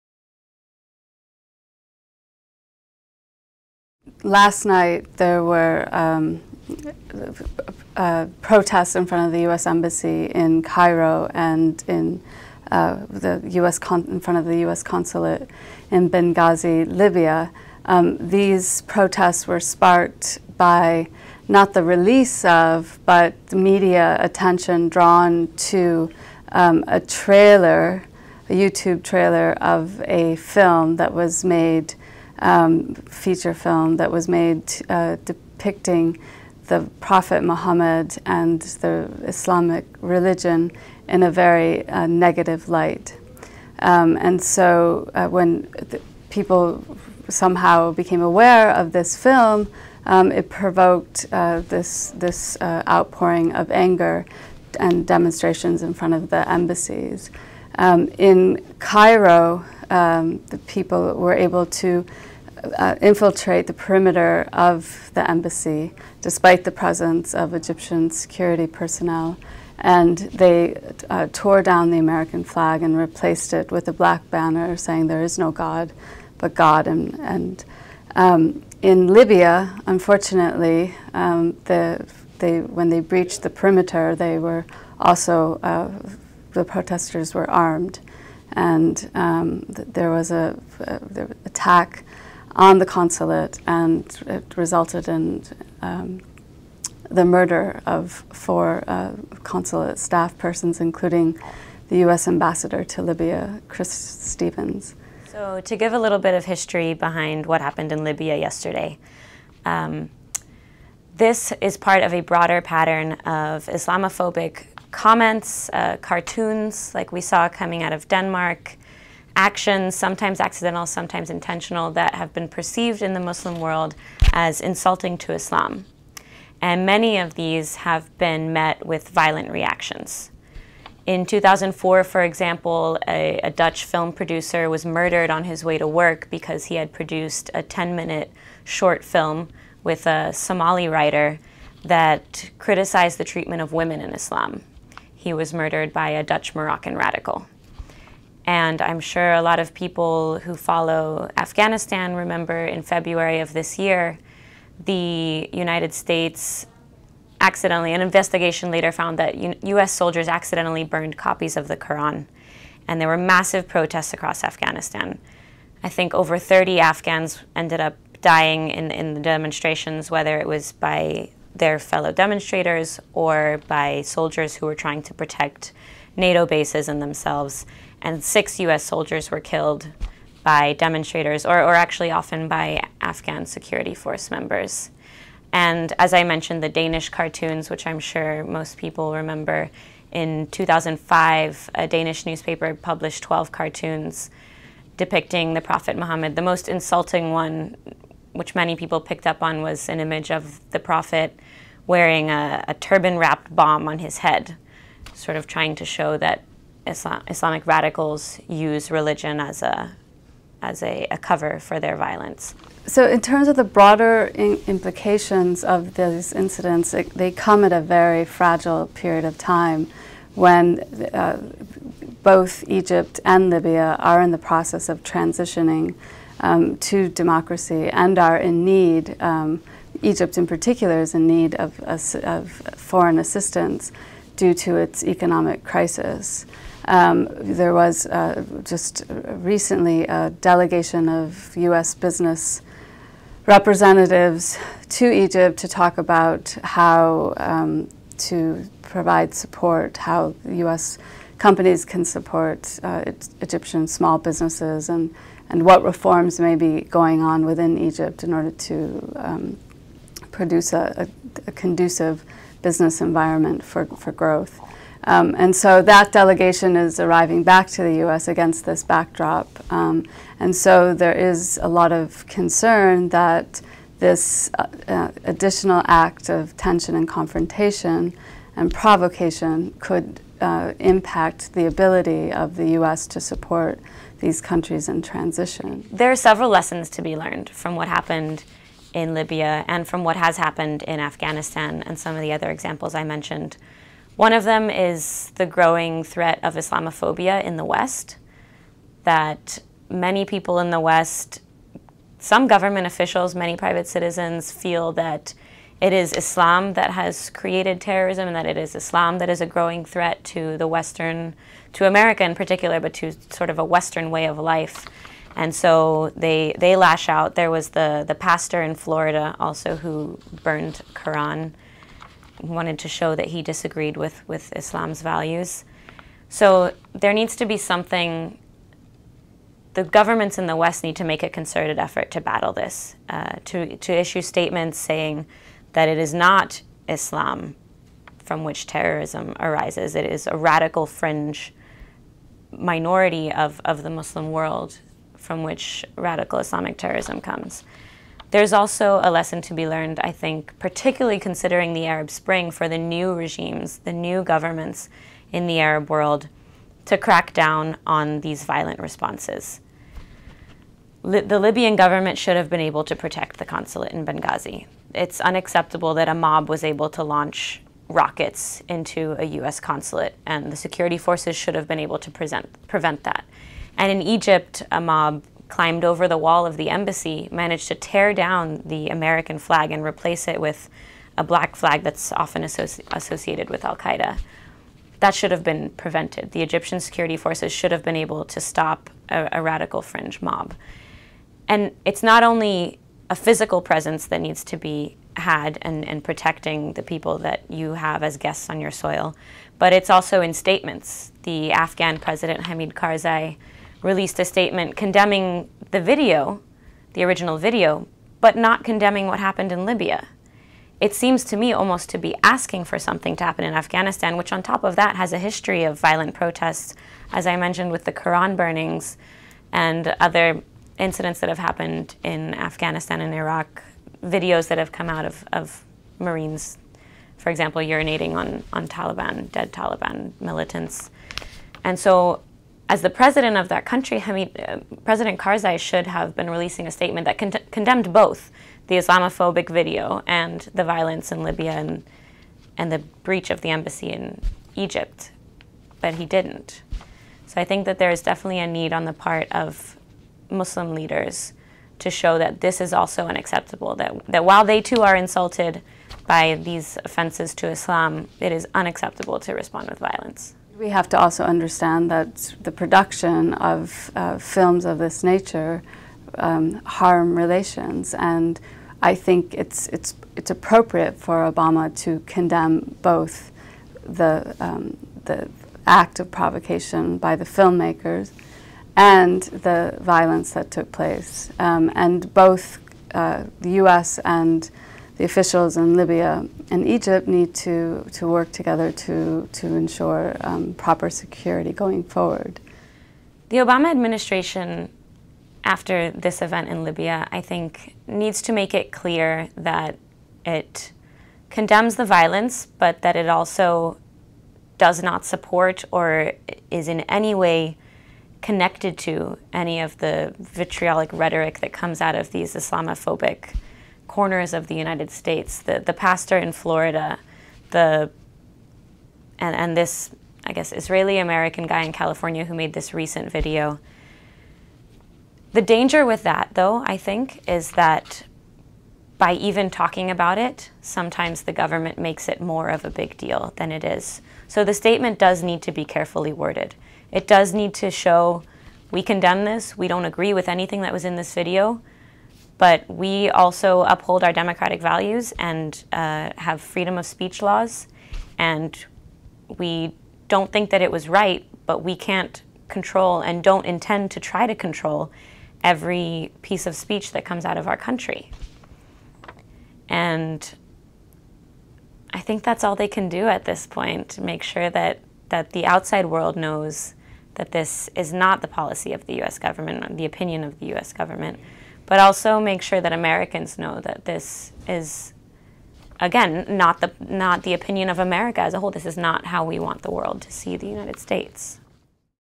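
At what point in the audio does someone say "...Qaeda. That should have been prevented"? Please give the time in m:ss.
6:23.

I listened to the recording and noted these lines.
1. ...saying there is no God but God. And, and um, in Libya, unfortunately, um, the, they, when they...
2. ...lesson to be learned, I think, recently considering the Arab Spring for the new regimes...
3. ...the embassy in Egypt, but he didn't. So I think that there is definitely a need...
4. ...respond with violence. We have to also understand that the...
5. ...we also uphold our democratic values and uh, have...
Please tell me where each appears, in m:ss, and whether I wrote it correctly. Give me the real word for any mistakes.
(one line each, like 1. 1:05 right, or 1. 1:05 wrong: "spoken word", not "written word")
1. 1:14 right
2. 5:49 wrong: "particularly", not "recently"
3. 7:23 right
4. 7:39 right
5. 9:02 right.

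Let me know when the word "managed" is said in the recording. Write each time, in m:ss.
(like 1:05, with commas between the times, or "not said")
6:17.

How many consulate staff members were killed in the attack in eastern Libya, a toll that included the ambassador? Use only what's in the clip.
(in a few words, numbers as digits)
4.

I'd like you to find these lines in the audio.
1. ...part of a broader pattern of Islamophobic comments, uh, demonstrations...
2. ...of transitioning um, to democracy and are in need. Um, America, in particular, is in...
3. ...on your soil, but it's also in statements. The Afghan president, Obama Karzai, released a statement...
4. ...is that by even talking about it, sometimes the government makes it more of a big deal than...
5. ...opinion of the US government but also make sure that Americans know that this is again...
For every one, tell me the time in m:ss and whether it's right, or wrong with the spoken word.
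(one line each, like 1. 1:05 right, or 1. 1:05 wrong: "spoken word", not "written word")
1. 1:51 wrong: "cartoons", not "demonstrations"
2. 3:44 wrong: "Egypt", not "America"
3. 6:38 wrong: "Hamid", not "Obama"
4. 8:47 right
5. 9:29 right.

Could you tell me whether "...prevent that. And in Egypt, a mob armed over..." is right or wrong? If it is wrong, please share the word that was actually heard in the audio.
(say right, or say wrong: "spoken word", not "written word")
wrong: "climbed", not "armed".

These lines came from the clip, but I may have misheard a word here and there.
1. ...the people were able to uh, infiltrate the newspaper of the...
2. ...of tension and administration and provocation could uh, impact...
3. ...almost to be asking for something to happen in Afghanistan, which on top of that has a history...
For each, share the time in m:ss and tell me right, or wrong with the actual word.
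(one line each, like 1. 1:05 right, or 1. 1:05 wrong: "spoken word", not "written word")
1. 1:00 wrong: "perimeter", not "newspaper"
2. 4:36 wrong: "confrontation", not "administration"
3. 6:51 right.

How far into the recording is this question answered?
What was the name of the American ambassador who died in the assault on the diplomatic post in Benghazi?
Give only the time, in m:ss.
1:43.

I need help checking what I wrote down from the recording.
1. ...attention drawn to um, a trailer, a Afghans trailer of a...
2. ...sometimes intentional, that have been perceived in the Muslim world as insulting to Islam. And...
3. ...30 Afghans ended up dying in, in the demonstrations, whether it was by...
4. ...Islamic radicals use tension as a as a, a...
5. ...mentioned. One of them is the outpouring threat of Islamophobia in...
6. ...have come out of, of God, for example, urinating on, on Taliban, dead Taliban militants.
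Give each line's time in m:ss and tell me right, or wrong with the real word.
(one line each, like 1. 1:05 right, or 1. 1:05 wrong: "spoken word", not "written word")
1. 0:24 wrong: "YouTube", not "Afghans"
2. 2:00 right
3. 2:46 right
4. 3:27 wrong: "religion", not "tension"
5. 4:53 wrong: "growing", not "outpouring"
6. 7:04 wrong: "Marines", not "God".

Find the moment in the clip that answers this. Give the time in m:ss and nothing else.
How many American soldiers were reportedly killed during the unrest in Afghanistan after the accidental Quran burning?
2:58.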